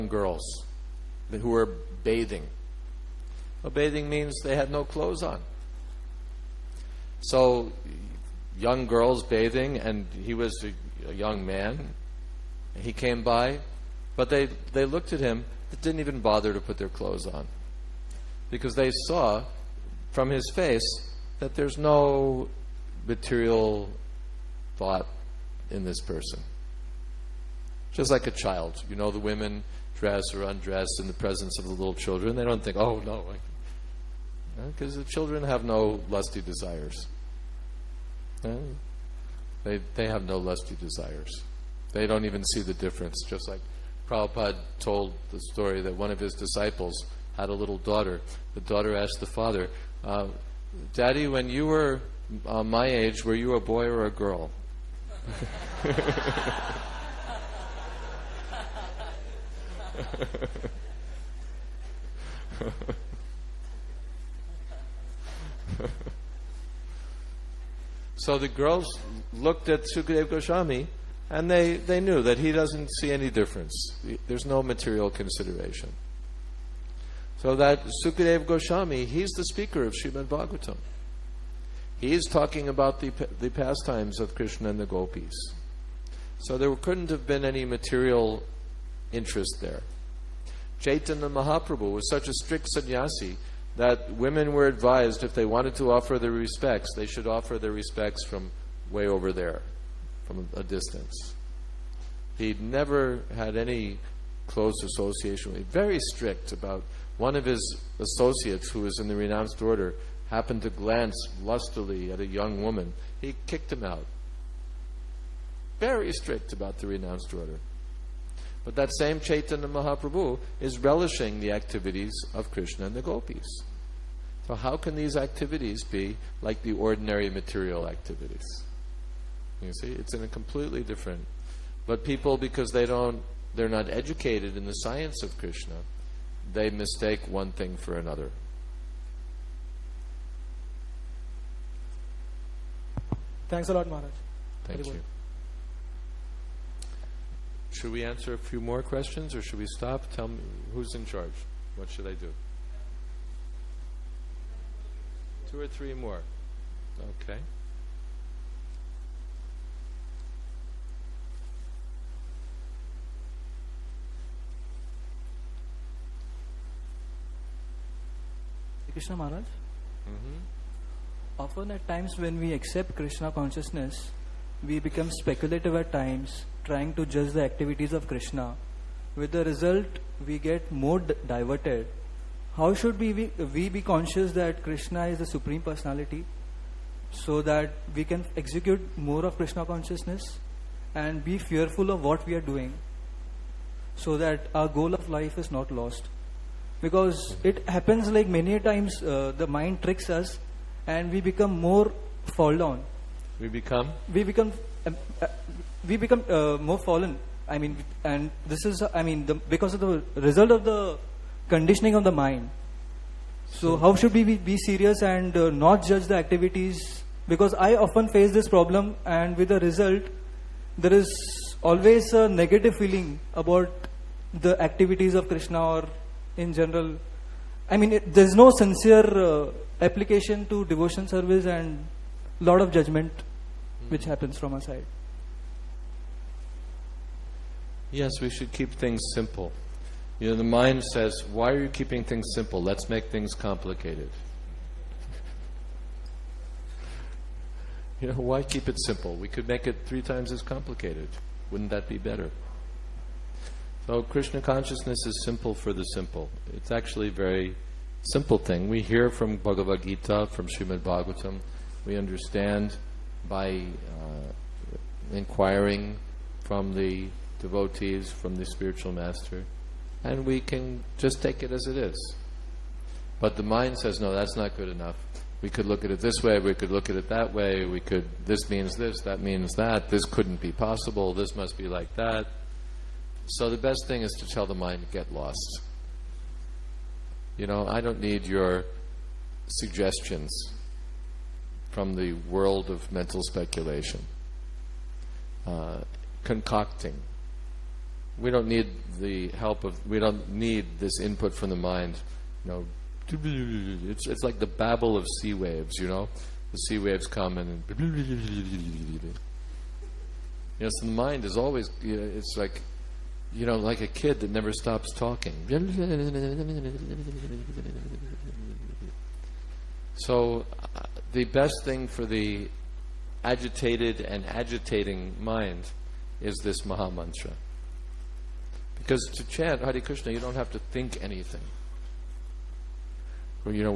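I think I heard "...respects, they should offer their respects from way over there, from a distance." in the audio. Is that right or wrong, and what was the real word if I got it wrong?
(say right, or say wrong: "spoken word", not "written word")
right.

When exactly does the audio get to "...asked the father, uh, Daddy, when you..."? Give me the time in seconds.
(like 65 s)
48 s.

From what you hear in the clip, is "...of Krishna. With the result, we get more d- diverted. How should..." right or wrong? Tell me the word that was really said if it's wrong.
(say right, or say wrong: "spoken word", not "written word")
right.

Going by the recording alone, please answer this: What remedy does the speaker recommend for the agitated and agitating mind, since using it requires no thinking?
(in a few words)
Maha Mantra.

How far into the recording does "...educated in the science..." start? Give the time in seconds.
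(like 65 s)
133 s.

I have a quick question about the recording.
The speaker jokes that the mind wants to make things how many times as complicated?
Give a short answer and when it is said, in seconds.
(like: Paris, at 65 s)
3, at 249 s.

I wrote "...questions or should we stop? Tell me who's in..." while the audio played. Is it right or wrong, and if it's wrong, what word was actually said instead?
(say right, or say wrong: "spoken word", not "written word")
right.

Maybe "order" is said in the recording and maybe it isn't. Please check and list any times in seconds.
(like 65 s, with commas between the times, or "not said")
109 s, 117 s.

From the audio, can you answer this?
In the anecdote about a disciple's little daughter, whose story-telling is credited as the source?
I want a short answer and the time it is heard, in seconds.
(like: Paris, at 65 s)
Prabhupada, at 44 s.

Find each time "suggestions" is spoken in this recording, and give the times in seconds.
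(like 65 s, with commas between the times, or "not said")
289 s.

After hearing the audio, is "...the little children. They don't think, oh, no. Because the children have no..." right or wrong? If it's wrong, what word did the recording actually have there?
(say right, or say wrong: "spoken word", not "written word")
right.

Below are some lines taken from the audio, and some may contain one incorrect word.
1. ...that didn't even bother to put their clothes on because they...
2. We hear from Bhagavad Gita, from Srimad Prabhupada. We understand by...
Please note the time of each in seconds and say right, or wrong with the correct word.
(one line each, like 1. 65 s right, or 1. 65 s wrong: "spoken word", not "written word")
1. 15 s right
2. 258 s wrong: "Bhagavatam", not "Prabhupada".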